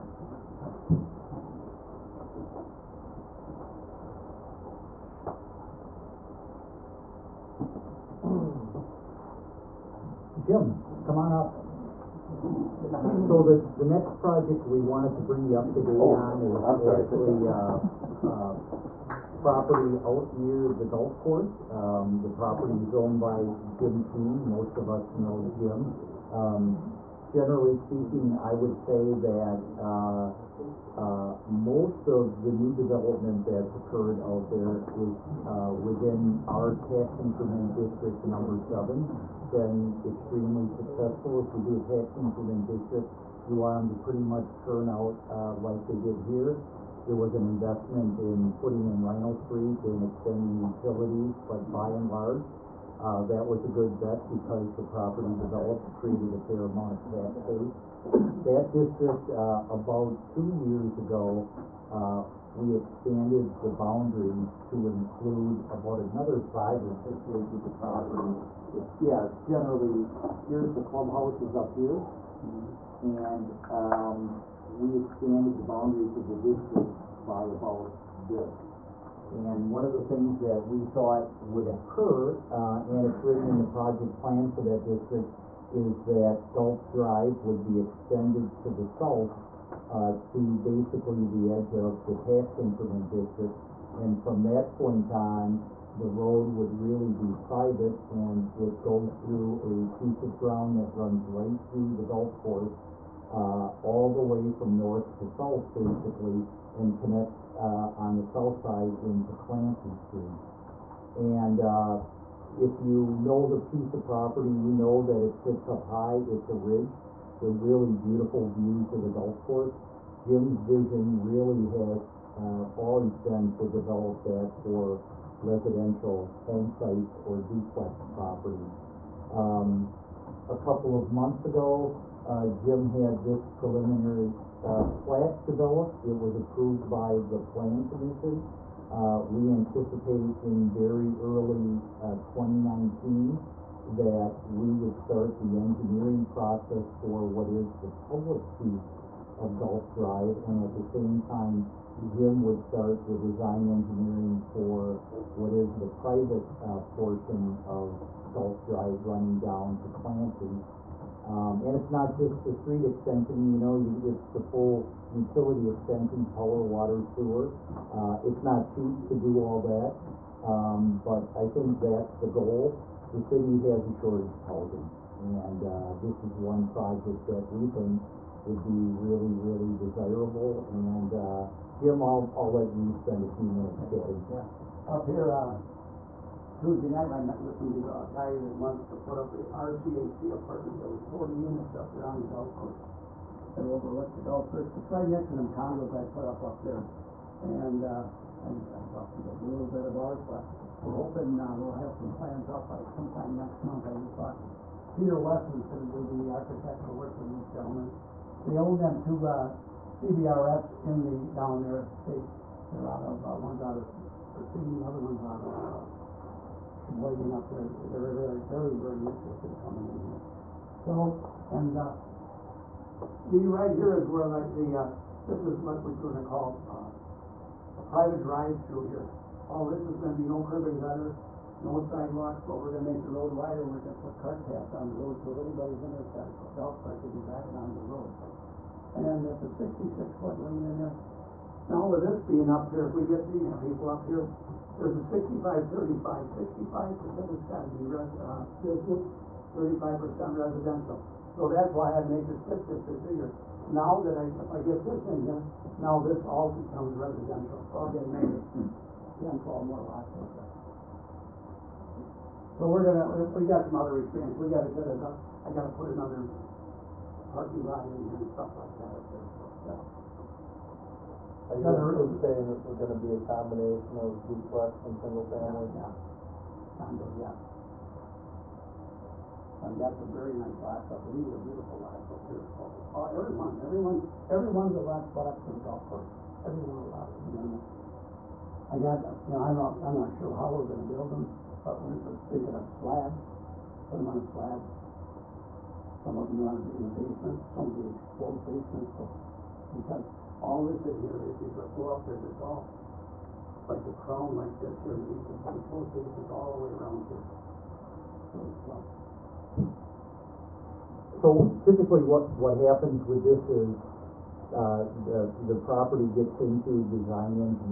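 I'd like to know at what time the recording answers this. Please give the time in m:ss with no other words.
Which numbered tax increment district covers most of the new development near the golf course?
0:38.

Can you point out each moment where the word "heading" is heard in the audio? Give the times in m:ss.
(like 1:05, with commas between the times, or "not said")
not said.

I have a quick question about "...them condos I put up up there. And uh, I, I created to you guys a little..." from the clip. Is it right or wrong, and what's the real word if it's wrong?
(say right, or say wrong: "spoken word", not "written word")
wrong: "talked", not "created".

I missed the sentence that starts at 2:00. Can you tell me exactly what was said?
Jim's vision really has uh, always been to develop that for residential home sites or duplex properties.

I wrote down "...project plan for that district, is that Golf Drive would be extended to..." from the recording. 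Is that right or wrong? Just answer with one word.
right.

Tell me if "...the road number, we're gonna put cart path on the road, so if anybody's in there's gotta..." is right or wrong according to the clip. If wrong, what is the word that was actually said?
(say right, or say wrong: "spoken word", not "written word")
wrong: "wider", not "number".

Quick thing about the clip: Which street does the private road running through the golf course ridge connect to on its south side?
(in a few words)
Clancy Street.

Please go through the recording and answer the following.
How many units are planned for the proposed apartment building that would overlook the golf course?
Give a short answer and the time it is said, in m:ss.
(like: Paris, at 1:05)
40, at 3:11.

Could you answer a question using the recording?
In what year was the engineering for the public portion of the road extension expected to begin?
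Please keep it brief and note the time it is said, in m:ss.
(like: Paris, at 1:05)
2019, at 2:22.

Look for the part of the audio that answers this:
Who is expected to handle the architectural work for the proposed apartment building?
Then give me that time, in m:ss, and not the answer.
3:24.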